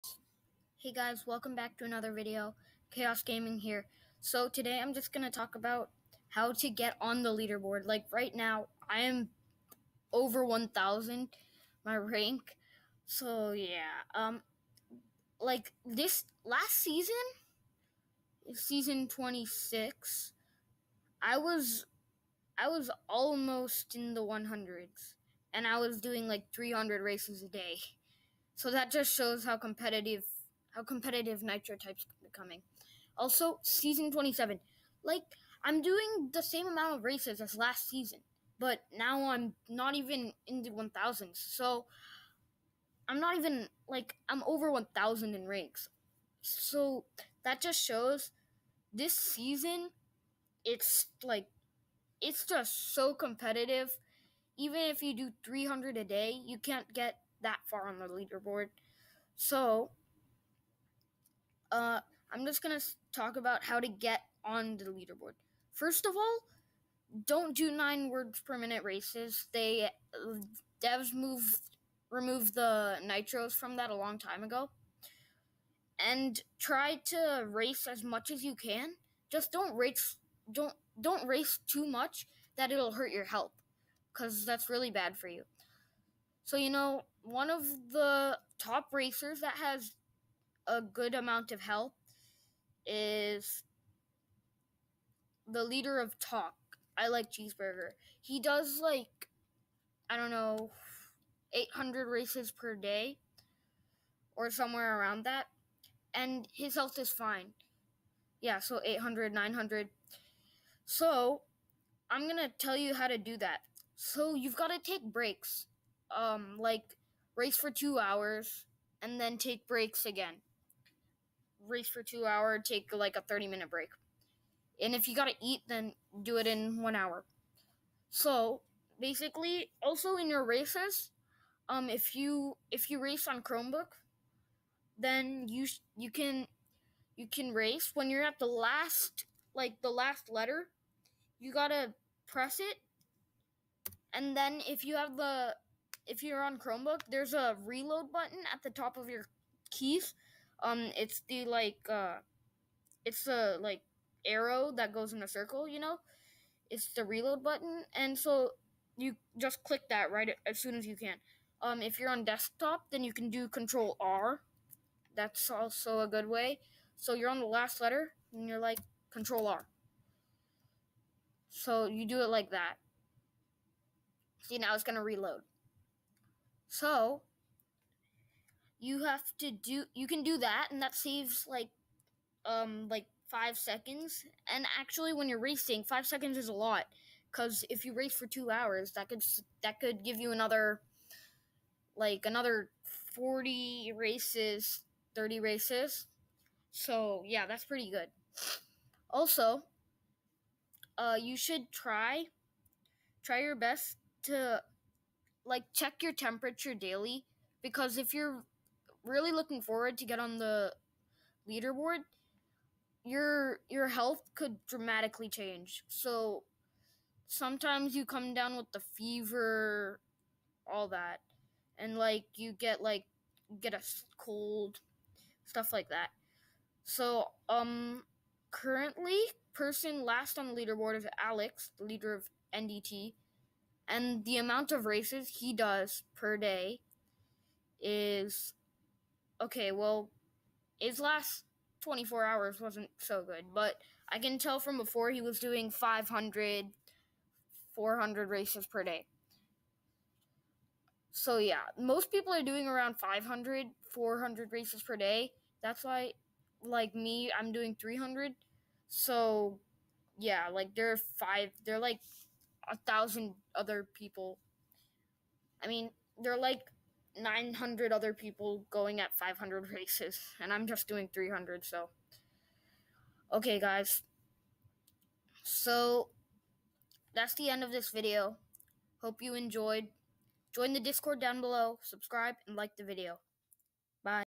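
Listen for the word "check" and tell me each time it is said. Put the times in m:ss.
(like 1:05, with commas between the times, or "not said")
3:25.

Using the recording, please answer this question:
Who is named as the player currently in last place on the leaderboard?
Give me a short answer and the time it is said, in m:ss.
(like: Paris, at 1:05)
Alex, at 3:51.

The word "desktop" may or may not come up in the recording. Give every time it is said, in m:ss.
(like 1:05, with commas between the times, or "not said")
2:42.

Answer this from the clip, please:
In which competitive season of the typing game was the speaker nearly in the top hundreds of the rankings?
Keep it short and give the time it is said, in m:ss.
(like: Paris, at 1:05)
26, at 0:18.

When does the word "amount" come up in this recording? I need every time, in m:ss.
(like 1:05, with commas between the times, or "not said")
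0:36, 1:31, 3:54.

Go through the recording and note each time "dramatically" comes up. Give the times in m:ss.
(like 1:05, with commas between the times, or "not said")
3:34.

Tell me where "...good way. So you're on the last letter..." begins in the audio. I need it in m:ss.
2:46.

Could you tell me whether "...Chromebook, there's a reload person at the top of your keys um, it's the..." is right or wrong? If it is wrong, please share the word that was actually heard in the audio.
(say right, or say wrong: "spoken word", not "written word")
wrong: "button", not "person".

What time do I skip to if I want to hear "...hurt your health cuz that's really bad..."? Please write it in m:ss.
1:22.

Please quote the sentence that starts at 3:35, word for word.
So sometimes you come down with the fever, all that, and like you get like get a cold, stuff like that.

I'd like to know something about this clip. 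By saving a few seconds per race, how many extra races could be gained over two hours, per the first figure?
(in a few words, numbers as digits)
40.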